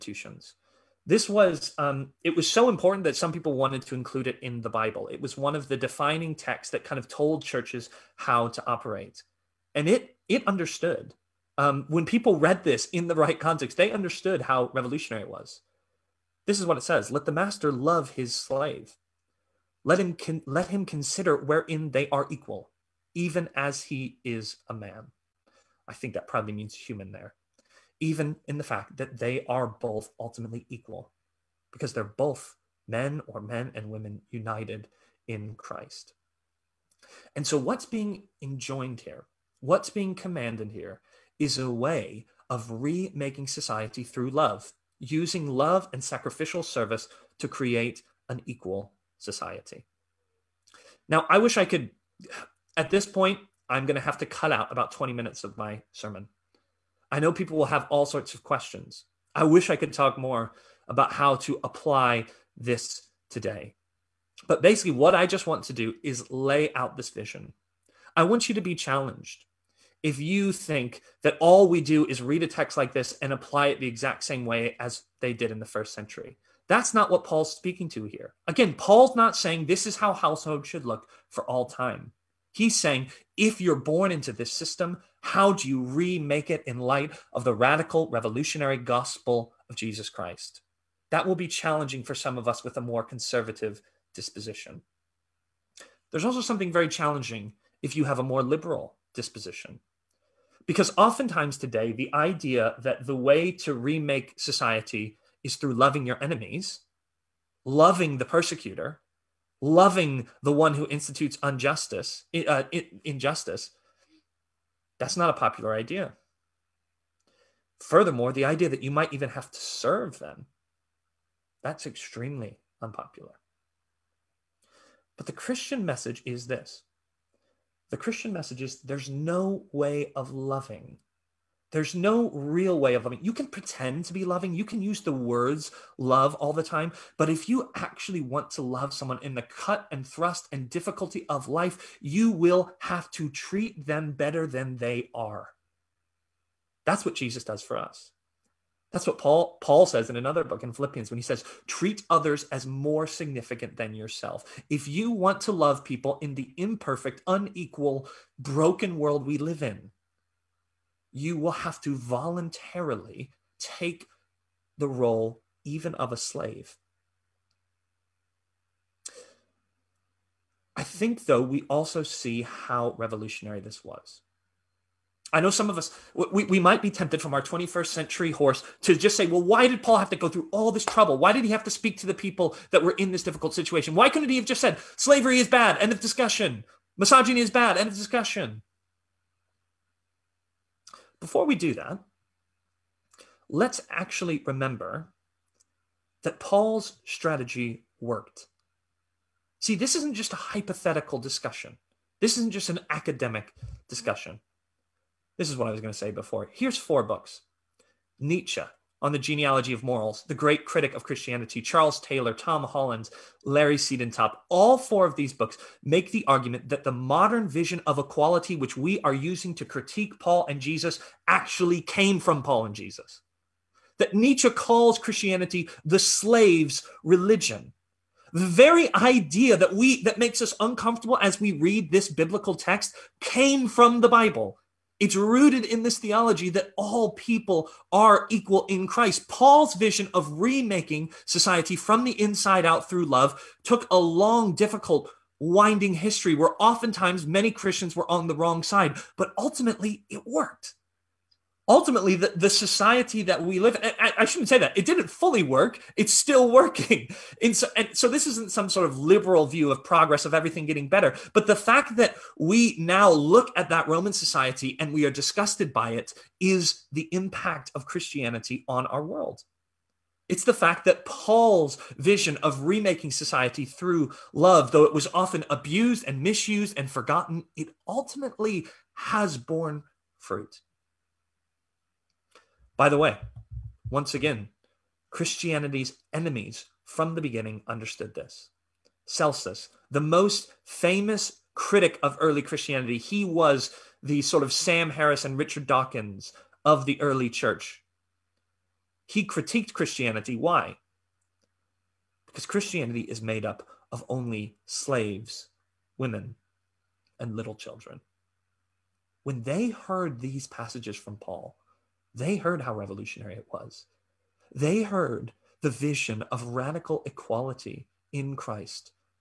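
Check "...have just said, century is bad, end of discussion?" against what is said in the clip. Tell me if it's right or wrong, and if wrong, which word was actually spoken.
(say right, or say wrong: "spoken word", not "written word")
wrong: "slavery", not "century".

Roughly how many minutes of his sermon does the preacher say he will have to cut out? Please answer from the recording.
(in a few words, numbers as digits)
20.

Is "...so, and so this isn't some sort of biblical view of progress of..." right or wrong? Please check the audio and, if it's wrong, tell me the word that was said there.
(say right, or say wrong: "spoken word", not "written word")
wrong: "liberal", not "biblical".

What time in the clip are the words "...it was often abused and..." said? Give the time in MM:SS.
04:34.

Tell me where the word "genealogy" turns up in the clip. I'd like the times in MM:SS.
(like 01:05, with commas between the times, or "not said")
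03:29.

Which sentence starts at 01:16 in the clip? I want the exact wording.
That's not what Paul's speaking to here.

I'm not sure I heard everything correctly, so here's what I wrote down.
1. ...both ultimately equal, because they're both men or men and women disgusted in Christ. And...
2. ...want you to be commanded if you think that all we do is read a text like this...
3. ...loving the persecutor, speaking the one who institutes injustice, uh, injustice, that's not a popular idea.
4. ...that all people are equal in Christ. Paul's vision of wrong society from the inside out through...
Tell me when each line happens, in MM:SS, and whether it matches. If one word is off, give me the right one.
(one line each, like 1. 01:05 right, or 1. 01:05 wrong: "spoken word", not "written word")
1. 00:29 wrong: "united", not "disgusted"
2. 01:08 wrong: "challenged", not "commanded"
3. 01:47 wrong: "loving", not "speaking"
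4. 03:56 wrong: "remaking", not "wrong".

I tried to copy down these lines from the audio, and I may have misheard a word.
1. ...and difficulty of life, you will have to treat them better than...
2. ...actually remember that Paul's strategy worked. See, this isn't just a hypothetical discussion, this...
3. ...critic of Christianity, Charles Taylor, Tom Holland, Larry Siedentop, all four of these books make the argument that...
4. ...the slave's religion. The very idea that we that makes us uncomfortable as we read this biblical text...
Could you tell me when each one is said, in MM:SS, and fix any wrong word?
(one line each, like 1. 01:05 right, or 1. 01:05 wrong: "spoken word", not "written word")
1. 02:20 right
2. 03:13 right
3. 03:30 right
4. 03:45 right.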